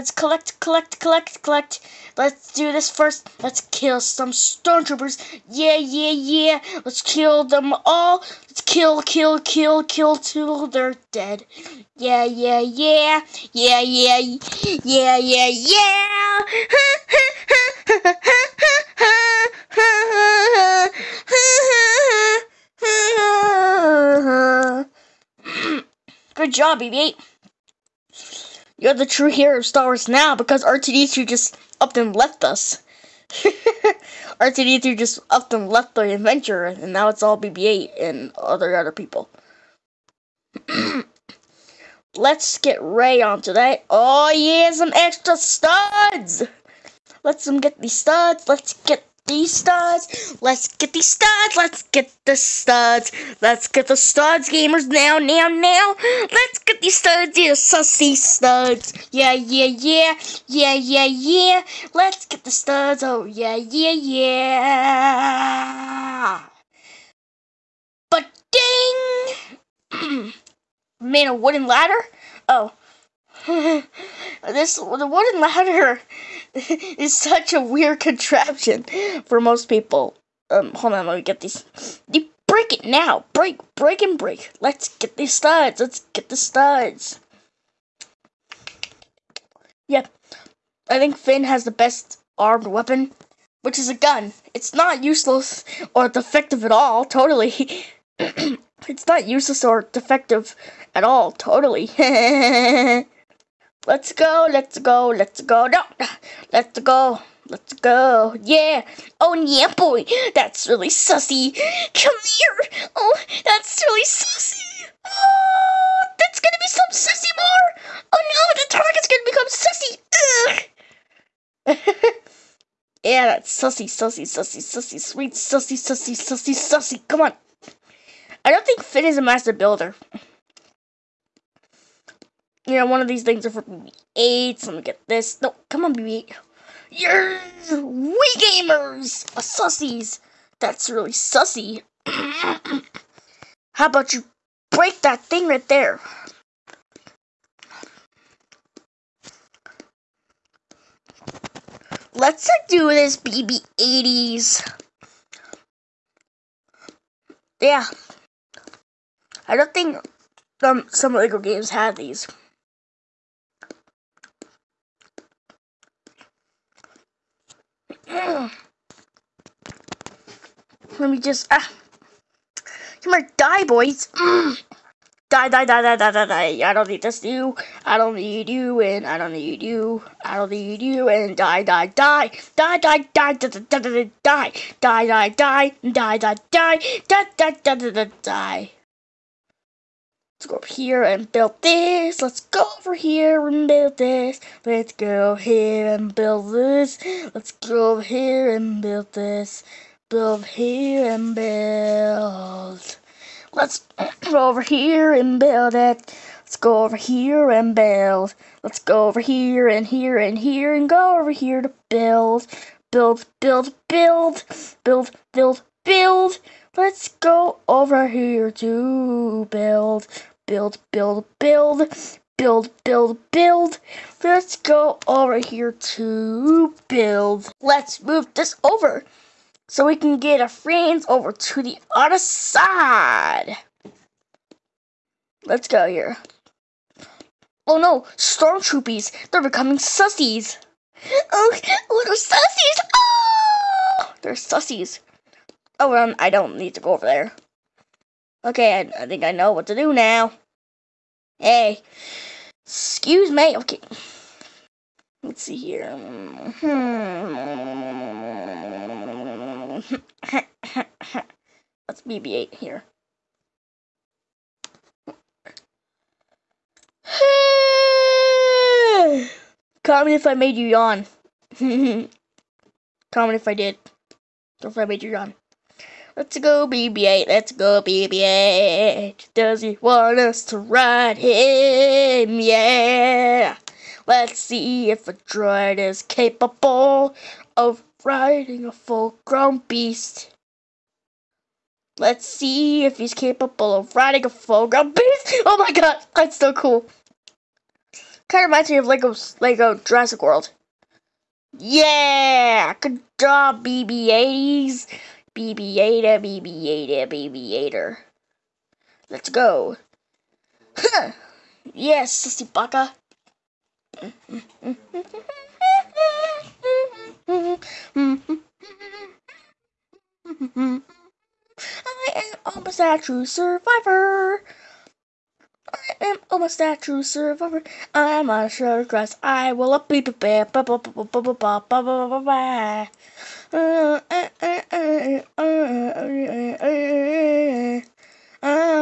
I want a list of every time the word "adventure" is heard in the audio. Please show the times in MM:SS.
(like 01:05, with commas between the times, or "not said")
00:36.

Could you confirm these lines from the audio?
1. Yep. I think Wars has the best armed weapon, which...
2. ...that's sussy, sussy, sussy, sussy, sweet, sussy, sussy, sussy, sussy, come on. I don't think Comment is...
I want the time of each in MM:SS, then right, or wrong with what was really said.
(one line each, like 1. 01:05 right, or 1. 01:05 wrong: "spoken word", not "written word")
1. 01:29 wrong: "Finn", not "Wars"
2. 02:03 wrong: "Finn", not "Comment".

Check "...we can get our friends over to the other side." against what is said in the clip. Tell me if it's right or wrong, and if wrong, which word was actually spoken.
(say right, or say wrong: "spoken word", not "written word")
right.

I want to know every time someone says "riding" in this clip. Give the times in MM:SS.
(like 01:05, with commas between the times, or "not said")
04:48, 04:53.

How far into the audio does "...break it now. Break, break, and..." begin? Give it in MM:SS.
01:22.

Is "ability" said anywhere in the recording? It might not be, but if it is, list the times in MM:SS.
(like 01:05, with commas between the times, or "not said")
not said.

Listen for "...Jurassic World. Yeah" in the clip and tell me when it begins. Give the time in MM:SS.
04:59.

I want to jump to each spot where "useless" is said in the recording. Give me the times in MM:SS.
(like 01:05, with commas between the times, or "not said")
01:35, 01:39.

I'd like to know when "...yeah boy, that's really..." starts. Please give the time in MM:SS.
01:49.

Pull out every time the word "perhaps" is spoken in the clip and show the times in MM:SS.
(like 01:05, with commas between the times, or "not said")
not said.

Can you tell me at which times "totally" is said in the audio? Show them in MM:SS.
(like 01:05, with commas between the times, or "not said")
01:37, 01:41.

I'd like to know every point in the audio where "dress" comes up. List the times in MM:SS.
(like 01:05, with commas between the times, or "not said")
05:28.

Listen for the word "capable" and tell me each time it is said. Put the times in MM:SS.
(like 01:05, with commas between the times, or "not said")
04:46, 04:53.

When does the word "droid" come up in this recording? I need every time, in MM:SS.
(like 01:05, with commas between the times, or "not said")
04:45.